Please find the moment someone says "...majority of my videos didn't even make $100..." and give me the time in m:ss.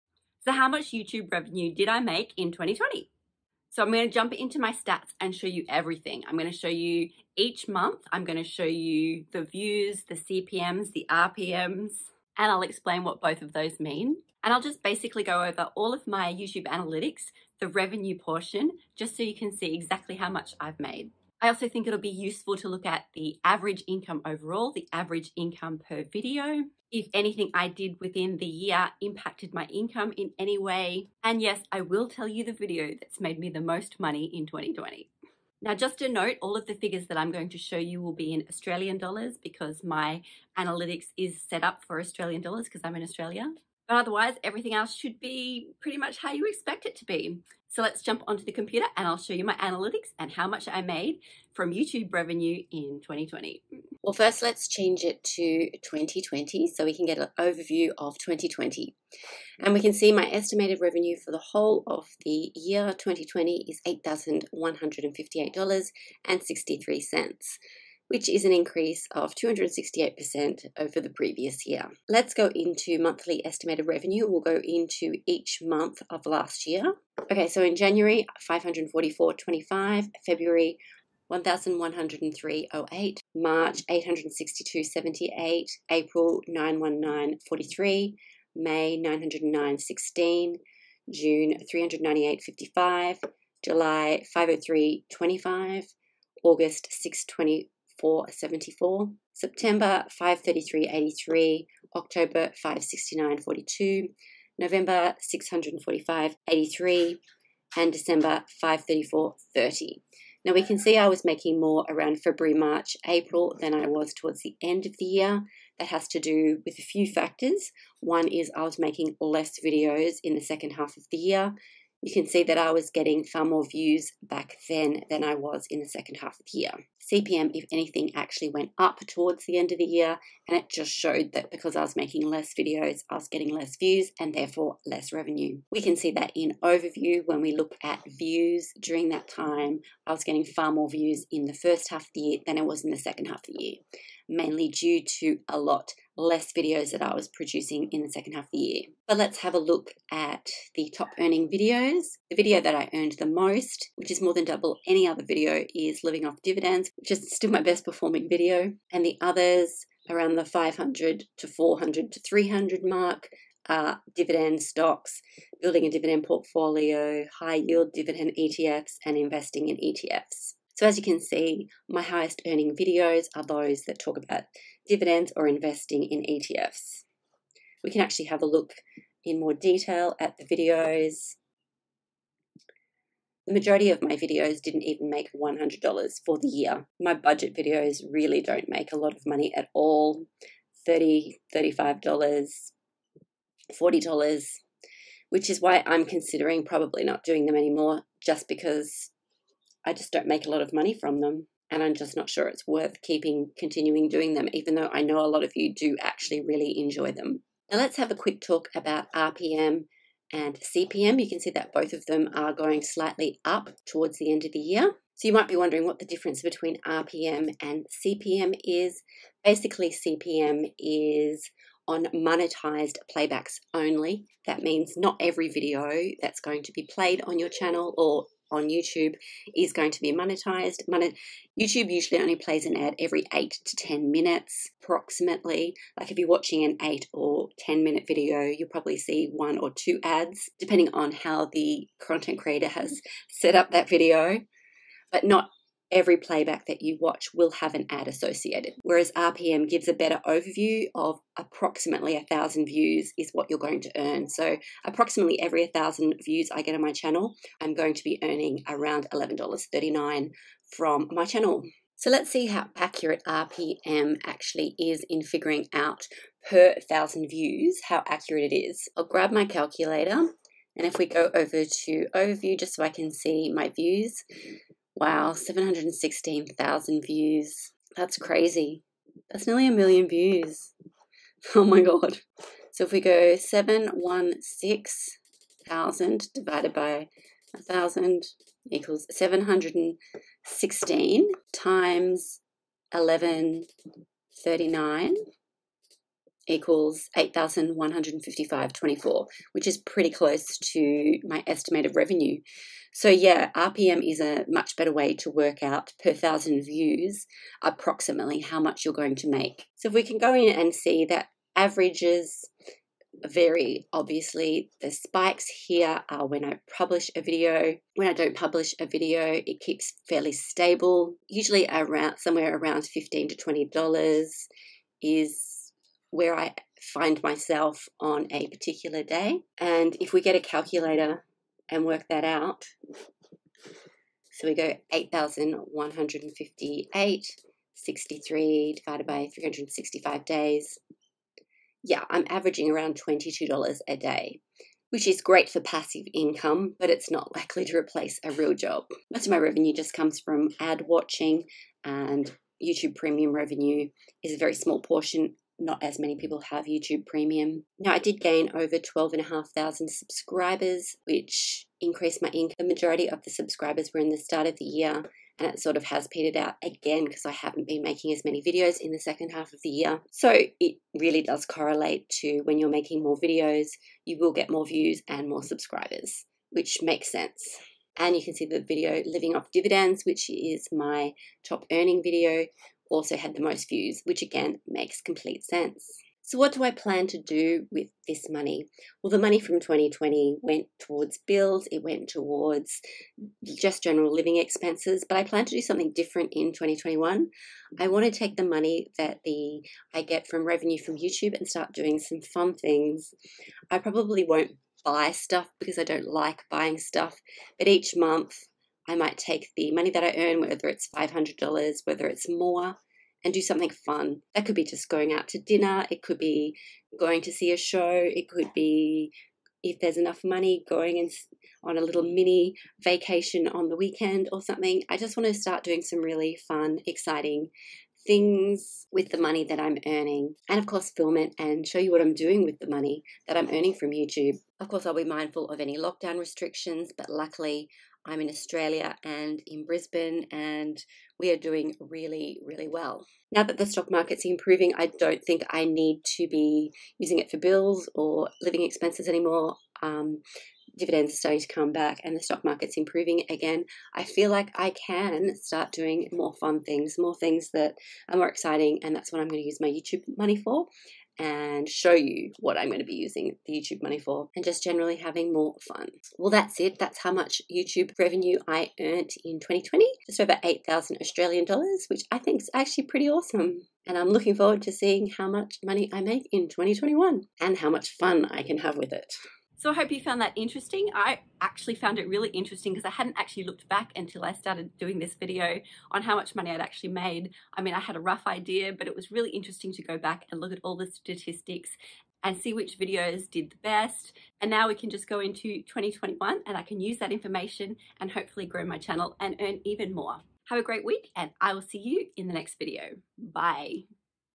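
3:03.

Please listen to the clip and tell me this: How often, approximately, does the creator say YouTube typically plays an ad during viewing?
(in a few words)
every 8 to 10 minutes.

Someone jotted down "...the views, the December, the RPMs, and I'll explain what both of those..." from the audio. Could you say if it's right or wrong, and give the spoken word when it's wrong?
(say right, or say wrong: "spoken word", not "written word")
wrong: "CPMs", not "December".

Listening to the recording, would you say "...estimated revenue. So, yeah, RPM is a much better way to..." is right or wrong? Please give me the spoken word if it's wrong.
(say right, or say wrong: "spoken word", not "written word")
right.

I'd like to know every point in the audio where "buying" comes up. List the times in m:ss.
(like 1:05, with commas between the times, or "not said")
6:46.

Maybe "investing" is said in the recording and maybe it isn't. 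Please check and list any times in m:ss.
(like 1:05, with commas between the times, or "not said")
2:49, 2:55.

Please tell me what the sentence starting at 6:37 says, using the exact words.
I want to take the money that the I get from revenue from YouTube and start doing some fun things.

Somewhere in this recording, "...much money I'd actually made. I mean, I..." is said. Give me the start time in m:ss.
8:06.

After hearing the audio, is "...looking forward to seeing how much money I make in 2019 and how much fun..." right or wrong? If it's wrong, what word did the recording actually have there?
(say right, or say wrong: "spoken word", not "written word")
wrong: "2021", not "2019".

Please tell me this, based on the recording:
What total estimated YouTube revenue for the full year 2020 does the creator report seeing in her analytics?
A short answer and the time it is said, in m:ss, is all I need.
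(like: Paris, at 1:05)
$8,158.63, at 1:03.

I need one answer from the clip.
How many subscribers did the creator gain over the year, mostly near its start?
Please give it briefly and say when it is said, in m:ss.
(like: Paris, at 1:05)
over 12,500, at 5:58.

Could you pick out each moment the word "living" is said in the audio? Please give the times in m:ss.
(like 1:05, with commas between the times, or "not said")
2:36, 6:19, 6:34, 7:28.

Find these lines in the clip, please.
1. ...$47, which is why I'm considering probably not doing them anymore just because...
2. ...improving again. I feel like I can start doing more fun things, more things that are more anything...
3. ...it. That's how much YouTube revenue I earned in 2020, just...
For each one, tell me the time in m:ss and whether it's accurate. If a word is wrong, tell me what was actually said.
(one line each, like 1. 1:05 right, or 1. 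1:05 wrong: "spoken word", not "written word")
1. 3:13 wrong: "40", not "47"
2. 7:32 wrong: "exciting", not "anything"
3. 7:46 right.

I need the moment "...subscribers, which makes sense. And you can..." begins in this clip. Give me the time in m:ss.
6:15.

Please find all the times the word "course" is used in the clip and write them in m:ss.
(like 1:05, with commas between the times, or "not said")
7:10, 7:14.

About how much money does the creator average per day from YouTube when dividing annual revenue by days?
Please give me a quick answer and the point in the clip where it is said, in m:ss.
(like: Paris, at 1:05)
$22, at 5:43.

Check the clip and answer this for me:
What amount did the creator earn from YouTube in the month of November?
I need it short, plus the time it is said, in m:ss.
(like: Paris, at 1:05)
645.83, at 1:45.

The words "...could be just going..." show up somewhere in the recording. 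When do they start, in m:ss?
6:54.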